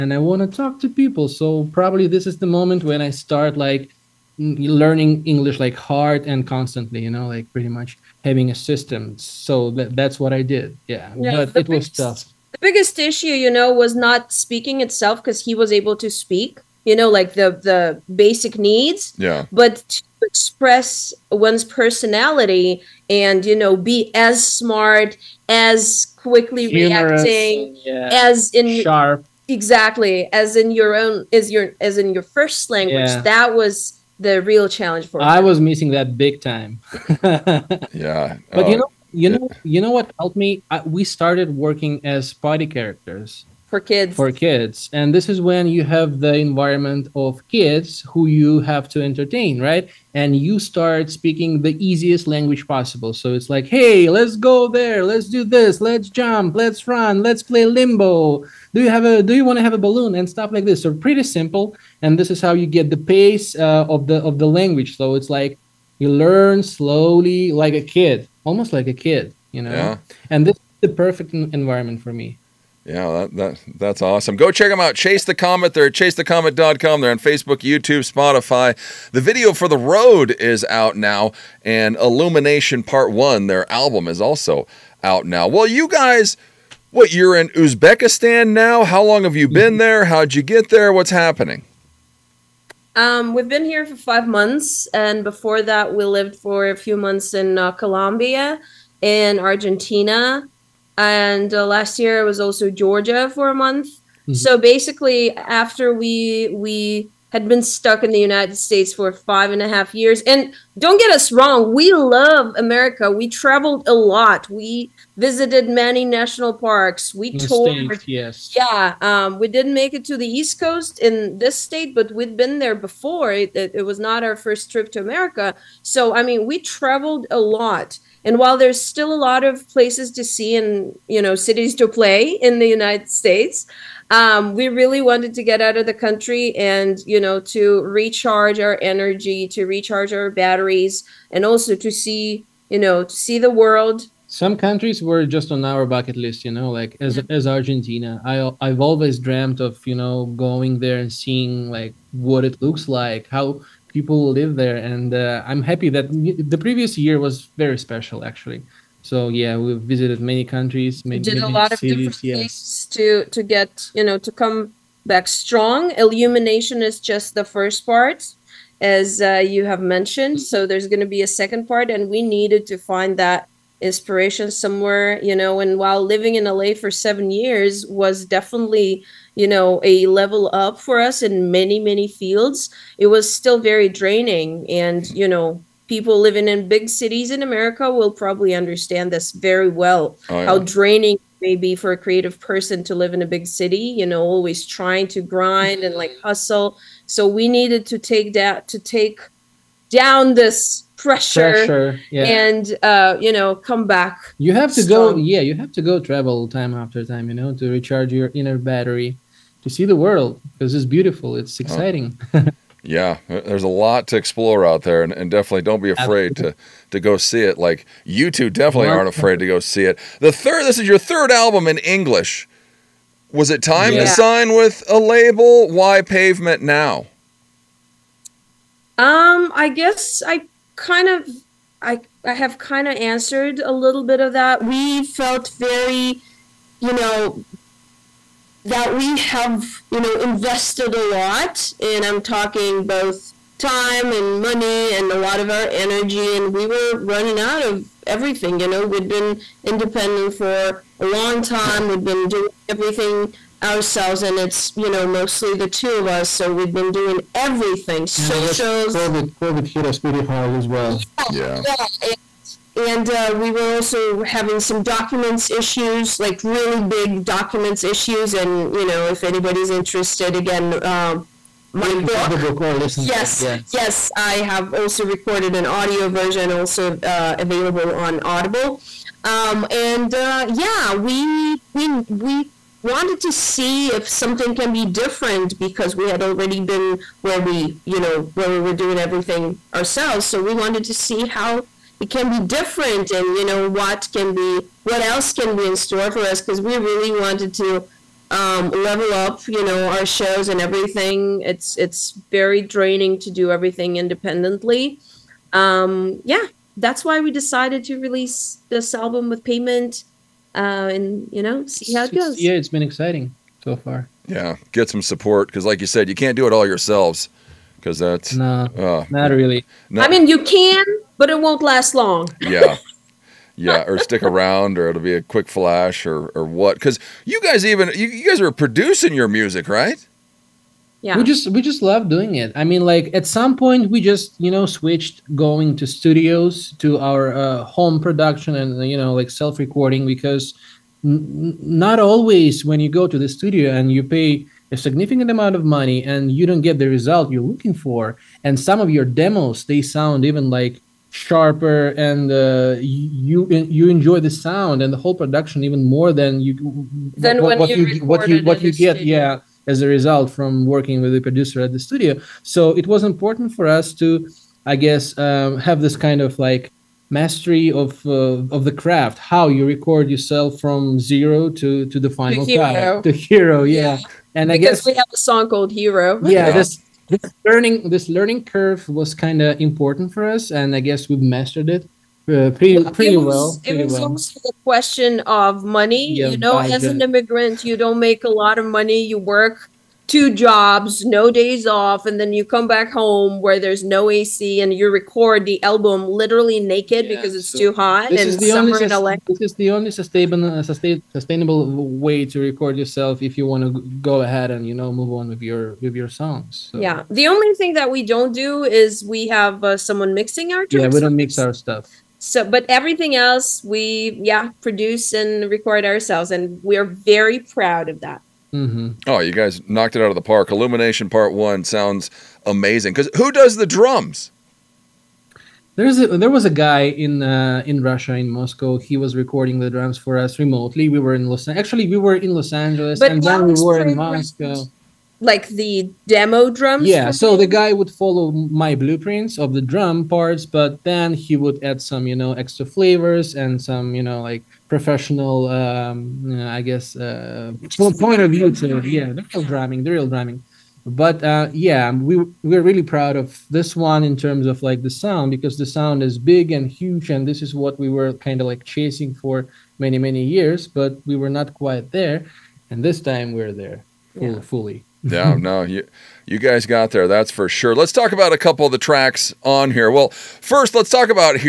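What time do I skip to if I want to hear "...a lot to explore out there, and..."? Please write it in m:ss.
3:33.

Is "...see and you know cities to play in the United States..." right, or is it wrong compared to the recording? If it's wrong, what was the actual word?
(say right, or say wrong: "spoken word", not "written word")
right.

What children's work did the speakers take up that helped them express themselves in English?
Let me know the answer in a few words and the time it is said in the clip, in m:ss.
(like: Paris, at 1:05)
Party characters, at 0:42.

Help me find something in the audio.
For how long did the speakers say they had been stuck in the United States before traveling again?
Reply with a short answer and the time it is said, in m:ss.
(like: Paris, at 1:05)
5 and a half years, at 1:49.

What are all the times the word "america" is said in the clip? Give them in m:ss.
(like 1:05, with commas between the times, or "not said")
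1:52, 2:04, 3:07.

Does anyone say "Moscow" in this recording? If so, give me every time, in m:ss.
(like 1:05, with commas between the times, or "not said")
7:08, 7:13.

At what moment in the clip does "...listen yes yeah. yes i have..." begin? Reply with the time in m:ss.
4:32.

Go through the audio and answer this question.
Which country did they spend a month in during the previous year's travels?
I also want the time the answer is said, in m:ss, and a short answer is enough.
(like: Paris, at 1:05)
Georgia, at 1:42.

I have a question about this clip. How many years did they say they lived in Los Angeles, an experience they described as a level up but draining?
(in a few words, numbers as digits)
7 years.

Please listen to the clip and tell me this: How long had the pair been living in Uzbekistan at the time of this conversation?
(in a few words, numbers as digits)
5 months.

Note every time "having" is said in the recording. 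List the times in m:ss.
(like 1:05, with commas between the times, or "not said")
0:08, 4:24.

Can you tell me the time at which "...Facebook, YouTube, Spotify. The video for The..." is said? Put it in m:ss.
1:17.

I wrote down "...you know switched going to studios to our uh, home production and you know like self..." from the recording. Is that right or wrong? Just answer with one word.
right.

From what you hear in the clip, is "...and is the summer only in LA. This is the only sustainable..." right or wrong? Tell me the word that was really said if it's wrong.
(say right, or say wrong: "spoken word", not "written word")
right.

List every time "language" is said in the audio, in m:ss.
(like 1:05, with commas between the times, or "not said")
0:32, 0:52, 1:04.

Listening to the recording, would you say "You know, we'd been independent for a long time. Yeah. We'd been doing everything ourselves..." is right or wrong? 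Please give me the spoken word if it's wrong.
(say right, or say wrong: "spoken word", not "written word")
right.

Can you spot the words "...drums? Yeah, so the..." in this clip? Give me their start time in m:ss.
7:16.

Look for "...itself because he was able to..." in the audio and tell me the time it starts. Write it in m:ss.
0:14.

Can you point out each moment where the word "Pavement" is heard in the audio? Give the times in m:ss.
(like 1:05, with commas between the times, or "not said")
3:46, 5:09.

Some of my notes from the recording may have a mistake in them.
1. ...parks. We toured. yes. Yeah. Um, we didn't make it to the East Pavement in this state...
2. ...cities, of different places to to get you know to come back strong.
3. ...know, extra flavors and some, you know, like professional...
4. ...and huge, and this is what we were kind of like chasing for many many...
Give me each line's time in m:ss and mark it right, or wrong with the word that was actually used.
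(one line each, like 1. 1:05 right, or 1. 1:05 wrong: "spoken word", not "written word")
1. 1:56 wrong: "Coast", not "Pavement"
2. 2:41 right
3. 7:22 right
4. 7:36 right.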